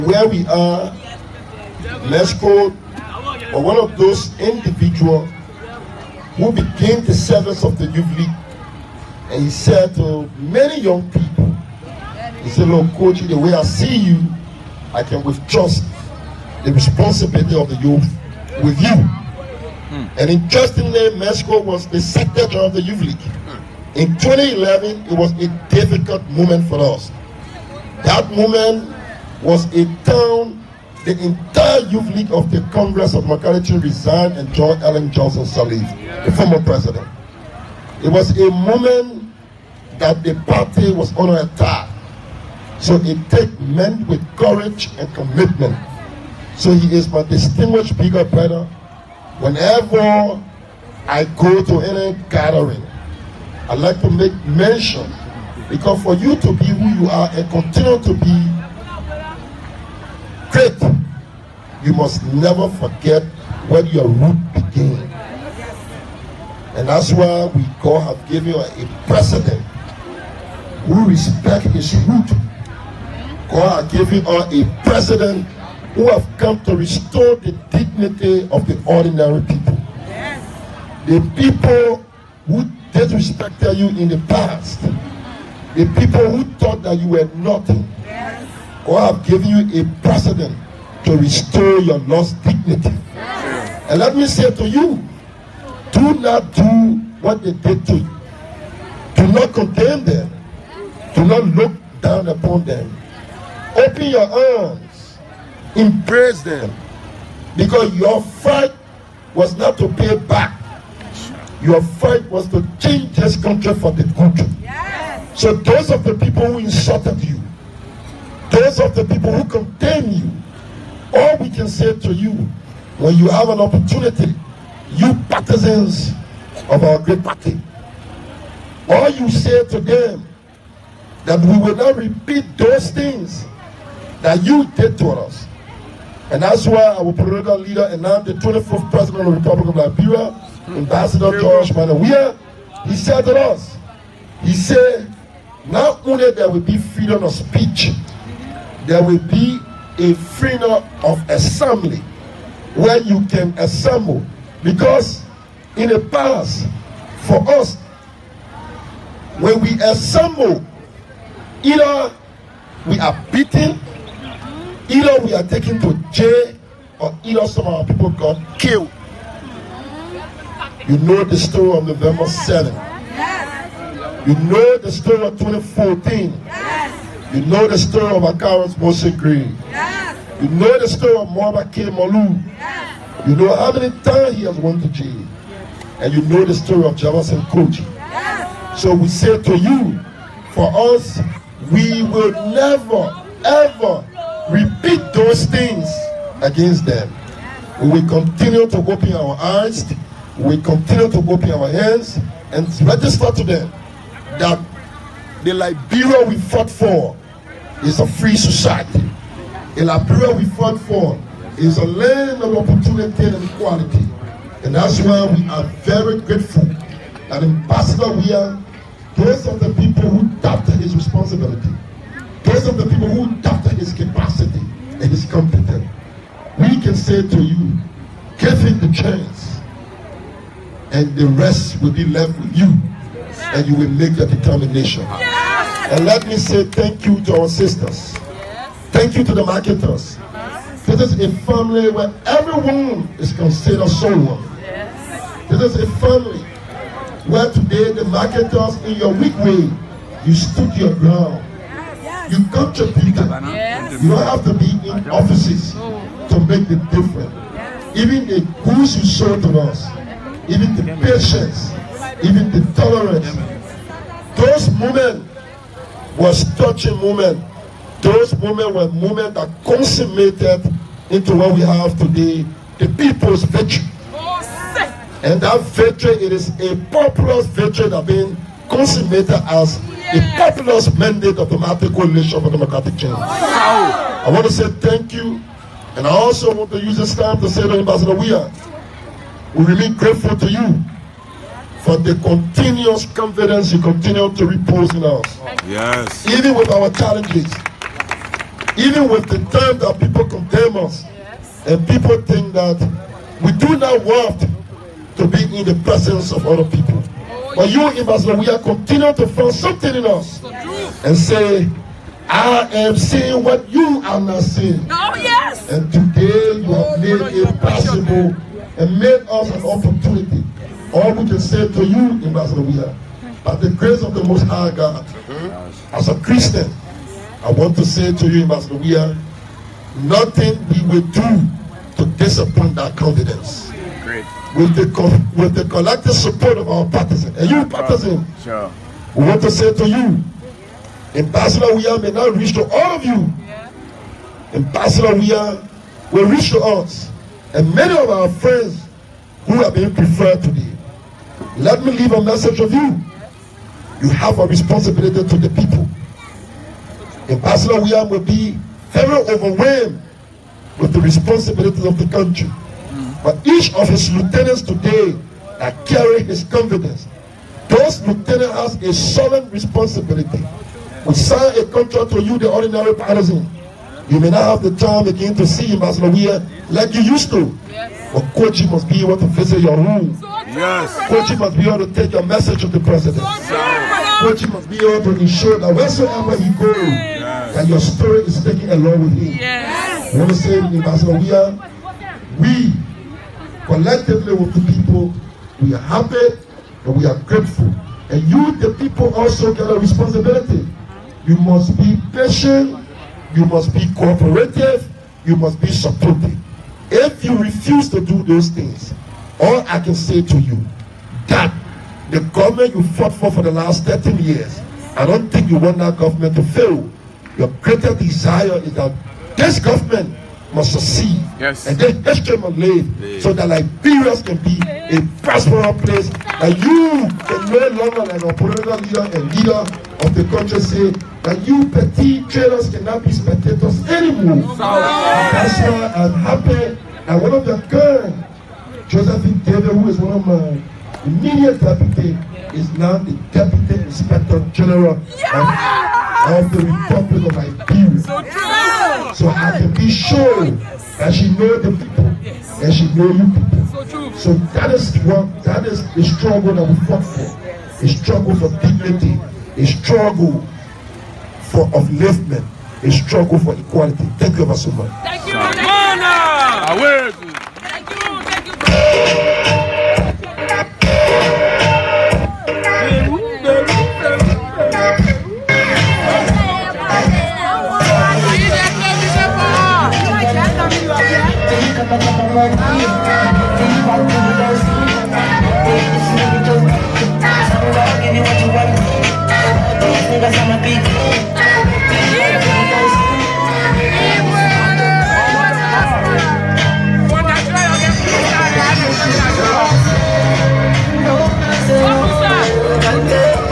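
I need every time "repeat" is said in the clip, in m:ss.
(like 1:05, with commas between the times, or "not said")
2:11, 3:14.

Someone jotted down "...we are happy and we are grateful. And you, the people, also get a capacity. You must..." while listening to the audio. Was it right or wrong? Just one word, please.
wrong.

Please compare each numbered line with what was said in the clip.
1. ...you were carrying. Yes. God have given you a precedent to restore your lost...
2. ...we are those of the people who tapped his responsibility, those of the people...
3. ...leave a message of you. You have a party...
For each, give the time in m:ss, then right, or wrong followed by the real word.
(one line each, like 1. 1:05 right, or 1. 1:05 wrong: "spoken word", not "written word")
1. 1:26 wrong: "nothing", not "carrying"
2. 3:38 right
3. 5:51 wrong: "responsibility", not "party".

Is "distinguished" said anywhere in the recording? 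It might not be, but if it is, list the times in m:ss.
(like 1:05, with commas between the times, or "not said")
0:47.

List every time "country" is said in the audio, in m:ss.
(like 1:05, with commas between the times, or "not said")
1:53, 6:02, 7:10.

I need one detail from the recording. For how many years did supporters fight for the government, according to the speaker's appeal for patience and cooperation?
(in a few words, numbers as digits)
13.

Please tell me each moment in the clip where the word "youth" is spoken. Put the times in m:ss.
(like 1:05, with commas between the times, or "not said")
0:07, 0:17, 0:22, 0:31.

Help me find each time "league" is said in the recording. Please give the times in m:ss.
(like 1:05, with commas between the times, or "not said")
0:08, 0:23, 0:32.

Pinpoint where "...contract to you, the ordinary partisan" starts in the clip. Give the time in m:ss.
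6:11.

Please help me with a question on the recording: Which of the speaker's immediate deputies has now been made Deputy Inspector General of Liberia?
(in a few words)
Josephine David.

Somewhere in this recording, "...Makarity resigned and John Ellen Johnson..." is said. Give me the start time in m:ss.
0:33.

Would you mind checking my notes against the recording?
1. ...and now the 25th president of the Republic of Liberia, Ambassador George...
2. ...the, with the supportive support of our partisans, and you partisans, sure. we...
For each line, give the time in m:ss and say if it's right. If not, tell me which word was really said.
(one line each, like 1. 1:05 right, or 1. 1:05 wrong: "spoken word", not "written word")
1. 2:17 right
2. 5:34 wrong: "collective", not "supportive".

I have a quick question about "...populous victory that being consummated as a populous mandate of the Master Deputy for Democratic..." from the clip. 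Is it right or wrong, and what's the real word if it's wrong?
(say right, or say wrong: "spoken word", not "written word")
wrong: "Coalition", not "Deputy".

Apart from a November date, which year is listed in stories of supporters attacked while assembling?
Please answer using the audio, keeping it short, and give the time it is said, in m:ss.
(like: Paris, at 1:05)
2014, at 2:55.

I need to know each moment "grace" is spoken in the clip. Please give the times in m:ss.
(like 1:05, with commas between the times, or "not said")
5:23.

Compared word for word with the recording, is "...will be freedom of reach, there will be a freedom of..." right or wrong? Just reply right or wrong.
wrong.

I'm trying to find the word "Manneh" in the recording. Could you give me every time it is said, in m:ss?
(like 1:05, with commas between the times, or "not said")
2:21.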